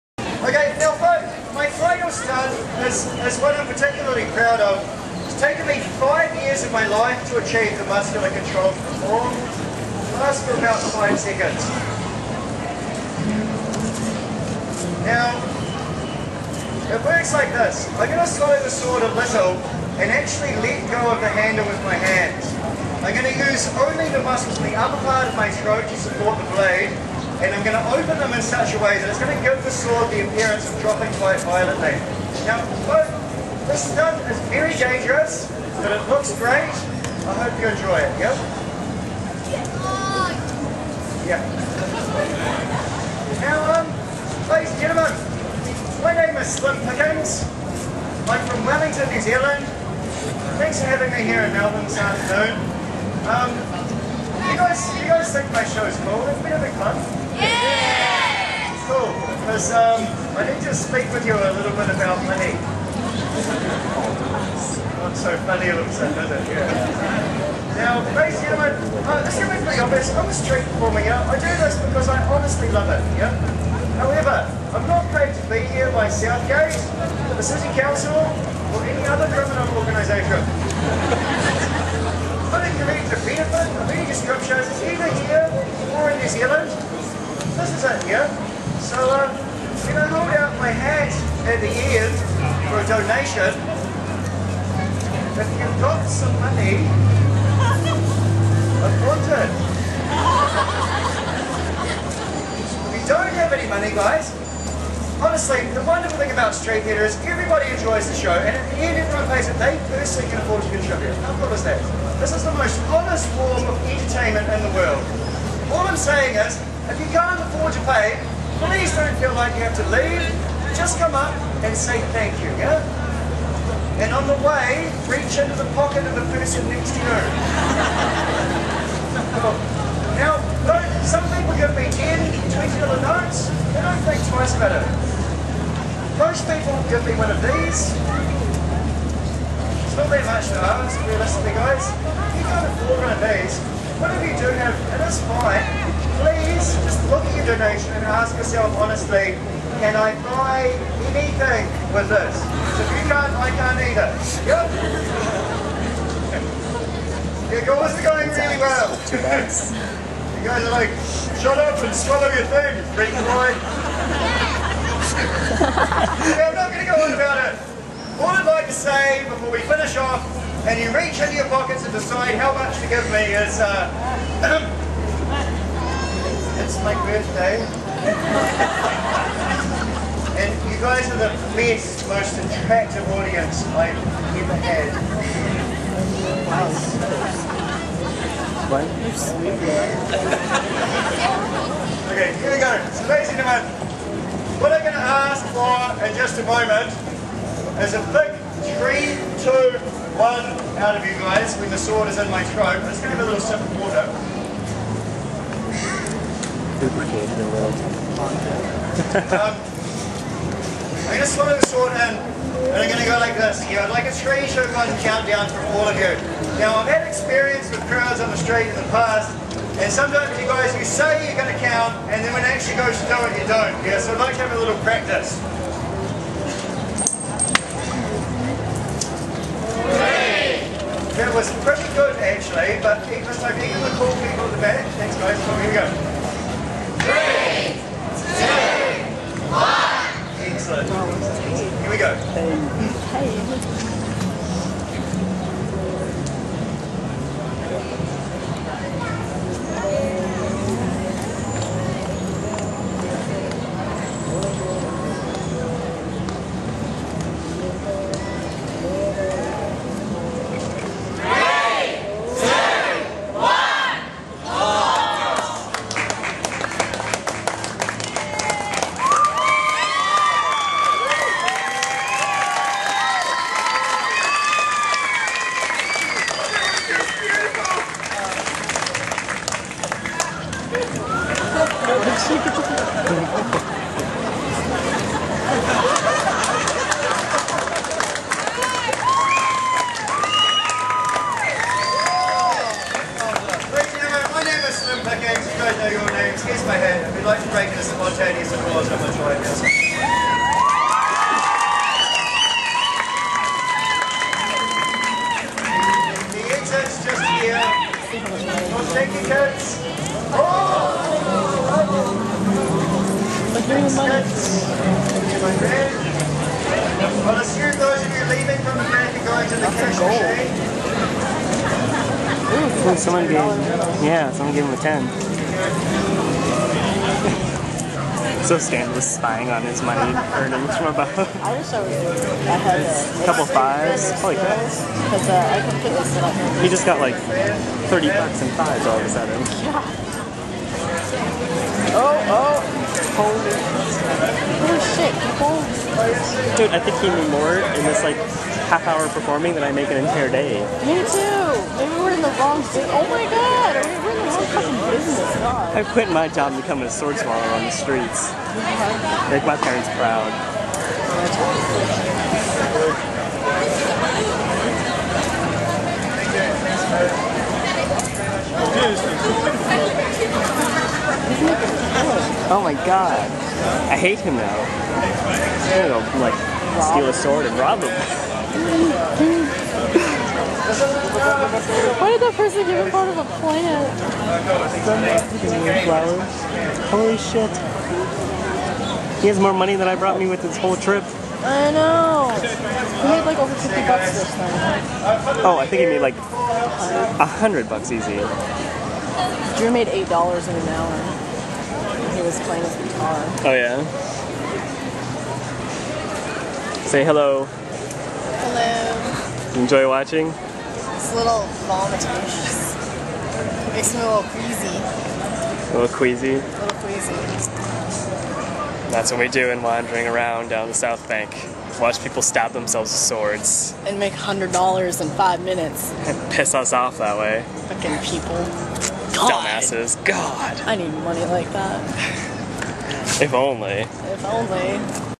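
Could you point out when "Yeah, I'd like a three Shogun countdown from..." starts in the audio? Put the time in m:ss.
3:33.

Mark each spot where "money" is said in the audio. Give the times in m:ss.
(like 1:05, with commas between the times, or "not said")
1:02, 1:36, 1:43, 5:29, 6:29, 7:11.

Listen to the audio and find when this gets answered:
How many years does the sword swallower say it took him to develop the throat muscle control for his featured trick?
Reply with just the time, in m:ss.
0:05.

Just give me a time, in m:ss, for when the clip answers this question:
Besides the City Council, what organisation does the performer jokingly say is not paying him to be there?
1:16.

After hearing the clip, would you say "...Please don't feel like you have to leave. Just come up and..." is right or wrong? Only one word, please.
right.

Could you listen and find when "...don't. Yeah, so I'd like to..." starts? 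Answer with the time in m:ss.
3:43.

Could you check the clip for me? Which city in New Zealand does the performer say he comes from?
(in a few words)
Wellington.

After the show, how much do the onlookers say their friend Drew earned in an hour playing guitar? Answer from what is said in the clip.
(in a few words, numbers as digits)
$8.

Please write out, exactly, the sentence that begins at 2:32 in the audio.
So if you can't, I can't either.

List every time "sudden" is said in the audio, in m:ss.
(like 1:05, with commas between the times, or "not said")
1:05, 5:39.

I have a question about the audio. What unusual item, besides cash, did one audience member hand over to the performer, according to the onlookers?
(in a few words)
Flowers.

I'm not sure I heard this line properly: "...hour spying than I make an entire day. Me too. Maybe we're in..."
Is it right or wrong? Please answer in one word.
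wrong.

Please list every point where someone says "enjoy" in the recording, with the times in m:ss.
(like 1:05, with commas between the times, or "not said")
0:37, 1:47, 6:49.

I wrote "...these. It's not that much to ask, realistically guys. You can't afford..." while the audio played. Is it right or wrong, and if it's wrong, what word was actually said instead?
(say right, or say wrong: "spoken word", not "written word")
right.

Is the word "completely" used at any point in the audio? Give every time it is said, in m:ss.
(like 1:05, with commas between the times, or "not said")
5:35.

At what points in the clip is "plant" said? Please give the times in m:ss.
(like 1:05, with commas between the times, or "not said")
6:23.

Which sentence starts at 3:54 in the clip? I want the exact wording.
Thanks guys, well, here we go.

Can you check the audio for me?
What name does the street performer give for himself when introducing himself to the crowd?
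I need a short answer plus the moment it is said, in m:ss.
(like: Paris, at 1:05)
Slim Pickens, at 0:46.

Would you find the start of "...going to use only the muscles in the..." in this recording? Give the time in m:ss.
0:23.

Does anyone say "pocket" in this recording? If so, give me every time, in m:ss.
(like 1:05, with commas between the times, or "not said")
2:05, 2:51.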